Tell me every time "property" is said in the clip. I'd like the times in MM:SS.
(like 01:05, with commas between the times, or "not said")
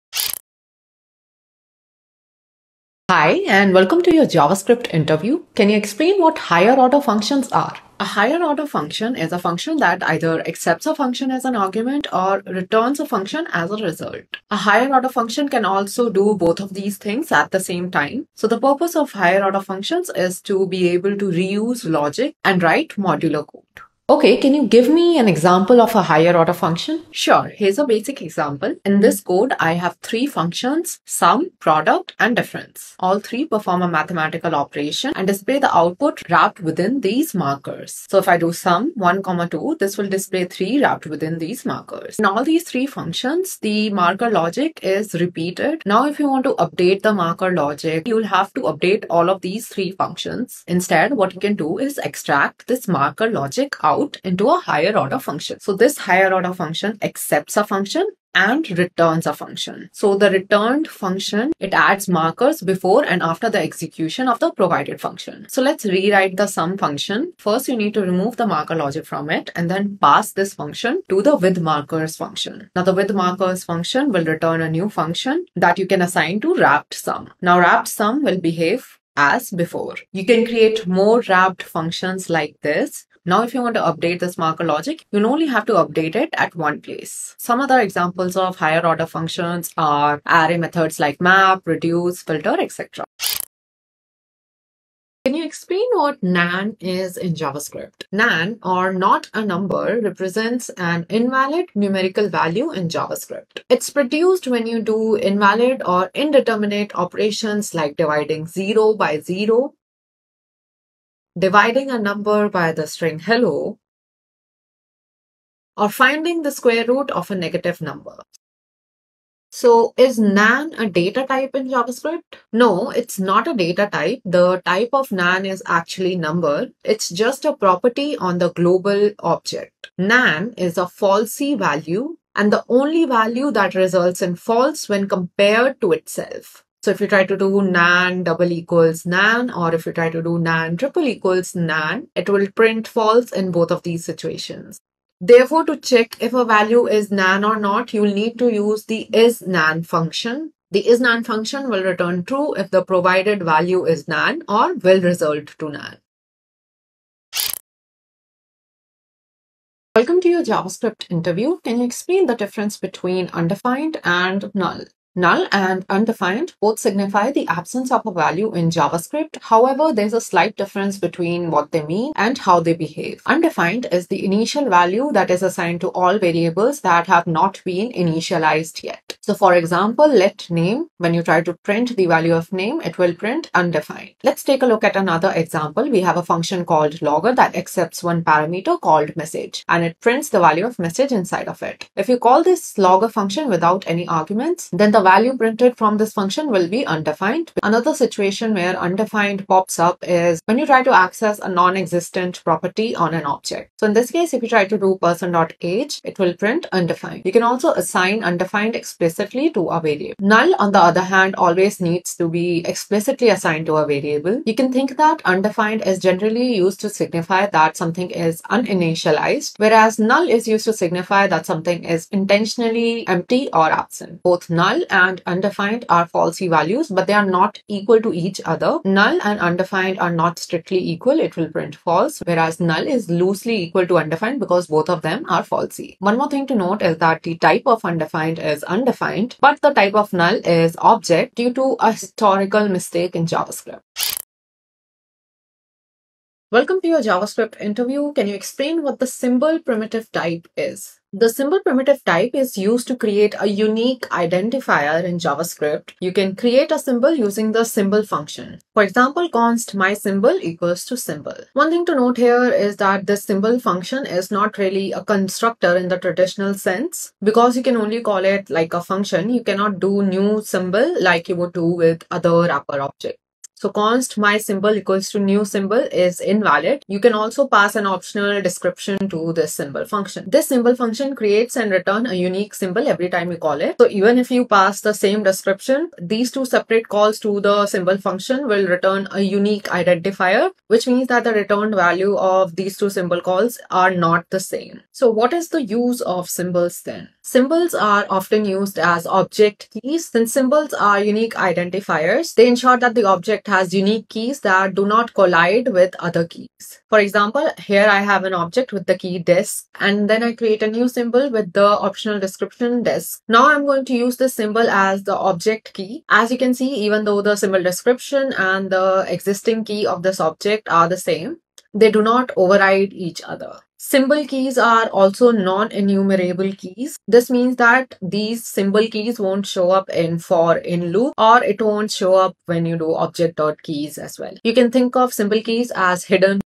02:07, 03:22.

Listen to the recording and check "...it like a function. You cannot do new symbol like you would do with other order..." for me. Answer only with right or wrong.
wrong.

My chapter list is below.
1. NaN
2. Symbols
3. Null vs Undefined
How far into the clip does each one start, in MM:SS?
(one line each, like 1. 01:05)
1. 01:33
2. 04:03
3. 02:37.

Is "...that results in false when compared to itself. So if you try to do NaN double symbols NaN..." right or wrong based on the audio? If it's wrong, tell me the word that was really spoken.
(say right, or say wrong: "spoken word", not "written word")
wrong: "equals", not "symbols".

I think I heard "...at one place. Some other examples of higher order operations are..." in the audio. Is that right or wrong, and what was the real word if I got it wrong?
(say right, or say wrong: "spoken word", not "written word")
wrong: "functions", not "operations".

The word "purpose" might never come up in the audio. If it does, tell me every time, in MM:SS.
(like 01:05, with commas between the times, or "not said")
00:18.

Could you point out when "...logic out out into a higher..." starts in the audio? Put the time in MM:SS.
00:53.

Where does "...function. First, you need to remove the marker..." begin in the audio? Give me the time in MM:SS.
01:06.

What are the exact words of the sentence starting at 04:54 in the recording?
So what is the use of symbols then?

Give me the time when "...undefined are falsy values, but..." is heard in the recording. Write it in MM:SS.
03:45.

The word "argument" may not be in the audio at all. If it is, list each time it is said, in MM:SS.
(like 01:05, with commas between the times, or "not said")
00:11, 03:14.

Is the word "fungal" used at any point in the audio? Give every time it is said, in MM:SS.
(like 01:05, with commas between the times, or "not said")
not said.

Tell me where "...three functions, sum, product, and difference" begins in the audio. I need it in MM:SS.
00:30.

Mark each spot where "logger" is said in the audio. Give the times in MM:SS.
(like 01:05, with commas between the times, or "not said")
03:07, 03:12.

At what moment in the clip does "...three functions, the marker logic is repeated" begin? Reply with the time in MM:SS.
00:42.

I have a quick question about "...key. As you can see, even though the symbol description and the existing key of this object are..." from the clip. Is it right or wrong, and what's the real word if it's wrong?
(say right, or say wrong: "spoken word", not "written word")
right.